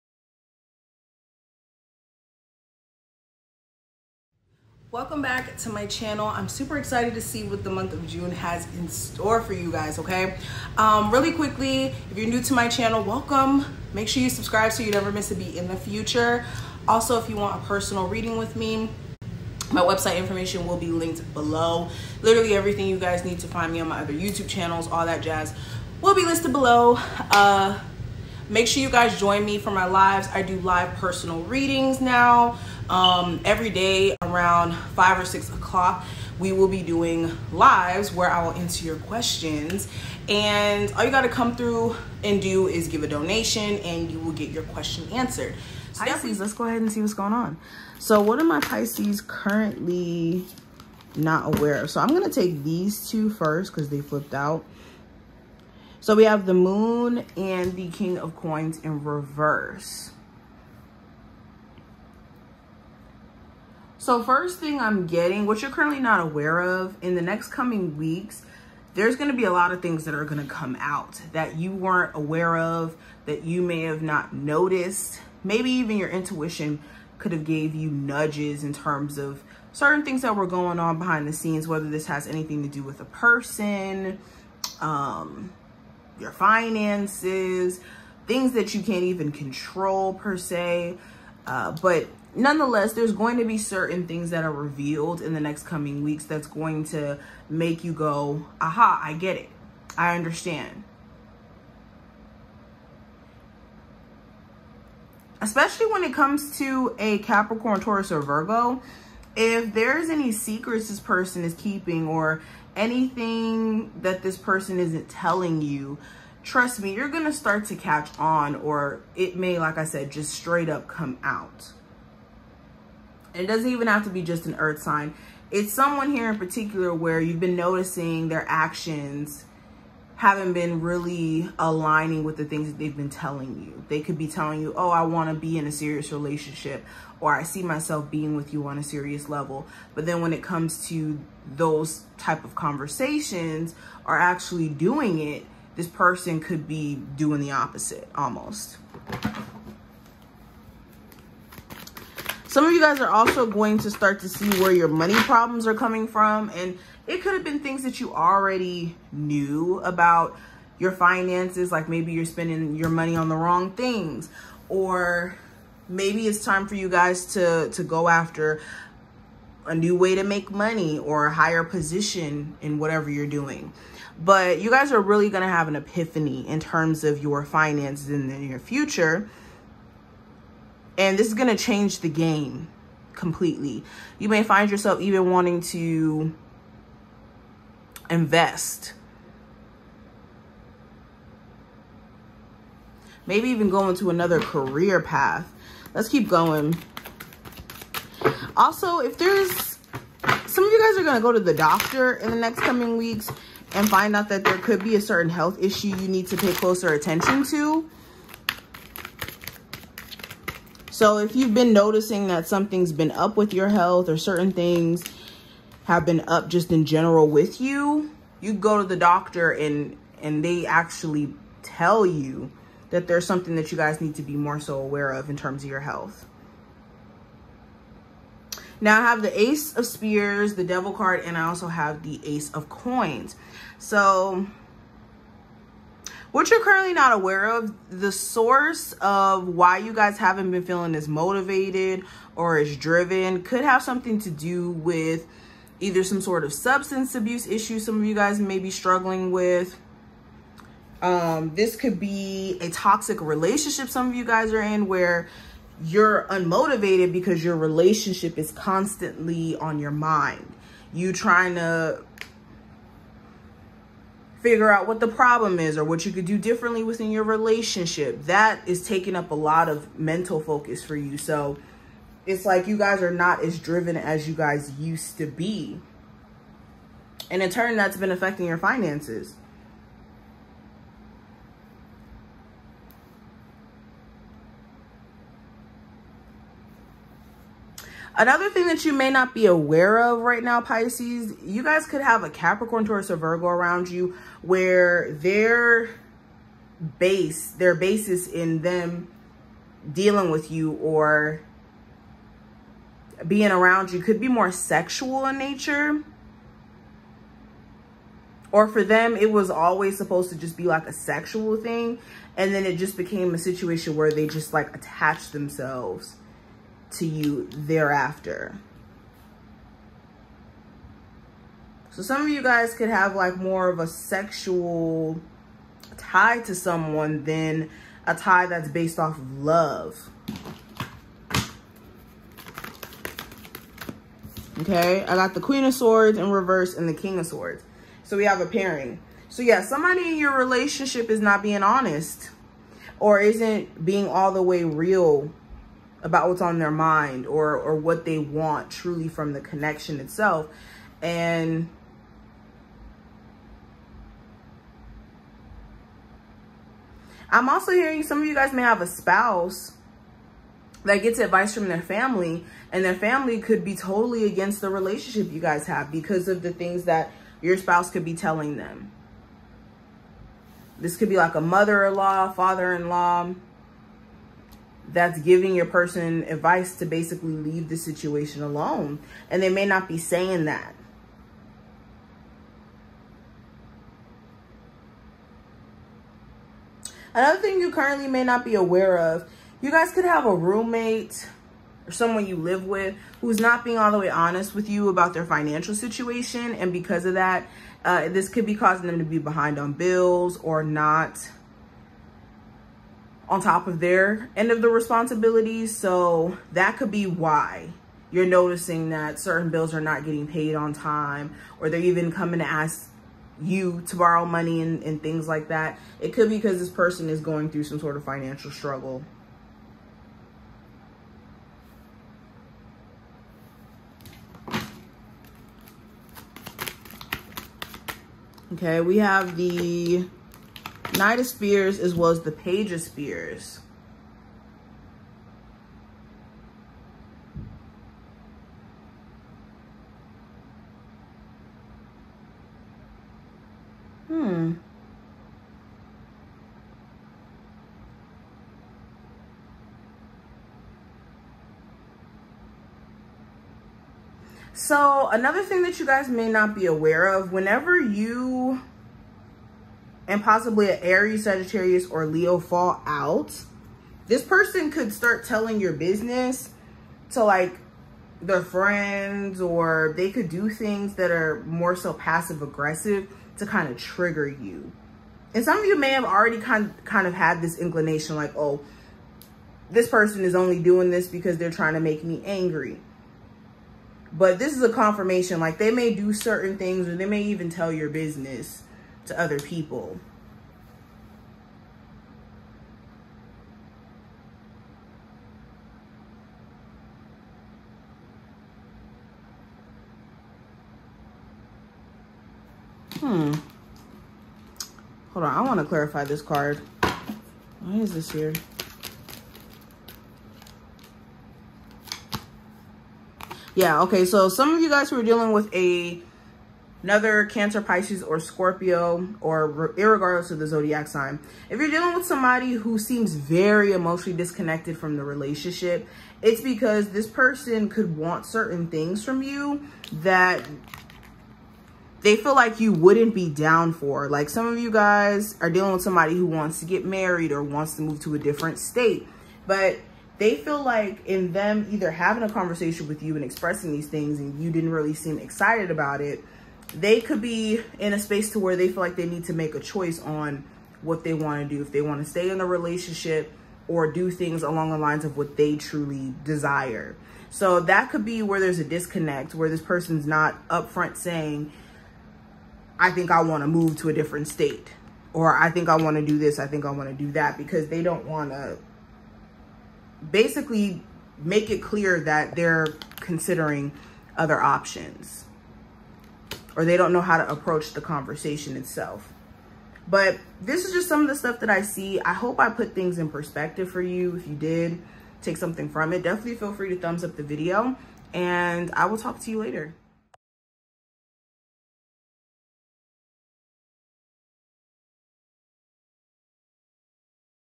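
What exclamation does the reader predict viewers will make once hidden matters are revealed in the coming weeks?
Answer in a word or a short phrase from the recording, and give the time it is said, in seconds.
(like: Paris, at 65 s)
aha, at 98 s.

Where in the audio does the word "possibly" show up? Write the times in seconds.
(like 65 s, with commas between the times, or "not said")
460 s.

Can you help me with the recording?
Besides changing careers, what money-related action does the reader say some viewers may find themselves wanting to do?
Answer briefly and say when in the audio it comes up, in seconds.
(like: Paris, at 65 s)
invest, at 188 s.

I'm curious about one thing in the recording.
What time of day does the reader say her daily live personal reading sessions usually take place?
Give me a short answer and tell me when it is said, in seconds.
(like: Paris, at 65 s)
5 or 6 o'clock, at 34 s.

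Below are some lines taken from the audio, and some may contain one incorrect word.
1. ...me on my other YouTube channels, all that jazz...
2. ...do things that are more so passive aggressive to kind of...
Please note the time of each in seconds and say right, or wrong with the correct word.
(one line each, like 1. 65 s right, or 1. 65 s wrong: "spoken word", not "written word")
1. 23 s right
2. 470 s right.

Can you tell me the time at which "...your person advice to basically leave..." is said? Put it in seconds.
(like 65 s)
375 s.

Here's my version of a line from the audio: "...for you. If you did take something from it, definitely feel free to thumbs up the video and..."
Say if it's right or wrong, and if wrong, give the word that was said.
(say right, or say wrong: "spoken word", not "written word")
right.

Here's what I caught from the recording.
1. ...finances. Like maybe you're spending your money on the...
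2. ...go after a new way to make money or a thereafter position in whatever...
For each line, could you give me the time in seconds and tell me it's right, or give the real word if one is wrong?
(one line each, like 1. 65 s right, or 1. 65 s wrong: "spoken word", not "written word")
1. 160 s right
2. 167 s wrong: "higher", not "thereafter".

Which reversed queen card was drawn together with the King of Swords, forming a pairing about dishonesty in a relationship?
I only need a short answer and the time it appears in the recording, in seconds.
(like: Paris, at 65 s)
Queen of Swords, at 335 s.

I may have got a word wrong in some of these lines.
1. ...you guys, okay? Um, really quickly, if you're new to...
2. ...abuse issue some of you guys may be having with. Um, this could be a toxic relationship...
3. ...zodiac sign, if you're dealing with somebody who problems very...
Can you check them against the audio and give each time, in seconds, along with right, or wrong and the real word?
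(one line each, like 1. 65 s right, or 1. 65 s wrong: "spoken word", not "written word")
1. 9 s right
2. 247 s wrong: "struggling", not "having"
3. 520 s wrong: "seems", not "problems".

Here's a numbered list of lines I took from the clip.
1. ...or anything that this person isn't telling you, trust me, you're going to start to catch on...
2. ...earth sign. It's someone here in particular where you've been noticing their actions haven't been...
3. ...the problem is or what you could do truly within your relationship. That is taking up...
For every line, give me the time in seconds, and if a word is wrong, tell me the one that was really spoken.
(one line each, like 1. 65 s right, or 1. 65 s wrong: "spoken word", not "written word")
1. 112 s right
2. 124 s right
3. 264 s wrong: "differently", not "truly".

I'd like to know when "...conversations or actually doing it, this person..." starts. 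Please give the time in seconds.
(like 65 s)
142 s.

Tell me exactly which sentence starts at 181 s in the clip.
And this is going to change the game completely.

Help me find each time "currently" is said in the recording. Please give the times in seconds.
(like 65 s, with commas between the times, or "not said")
49 s, 65 s, 236 s, 387 s.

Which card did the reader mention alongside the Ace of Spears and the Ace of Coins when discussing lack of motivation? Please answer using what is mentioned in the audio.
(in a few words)
The Devil.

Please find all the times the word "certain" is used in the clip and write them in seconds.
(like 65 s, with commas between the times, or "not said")
79 s, 93 s, 205 s, 214 s, 409 s, 486 s, 528 s.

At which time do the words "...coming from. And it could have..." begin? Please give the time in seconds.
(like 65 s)
155 s.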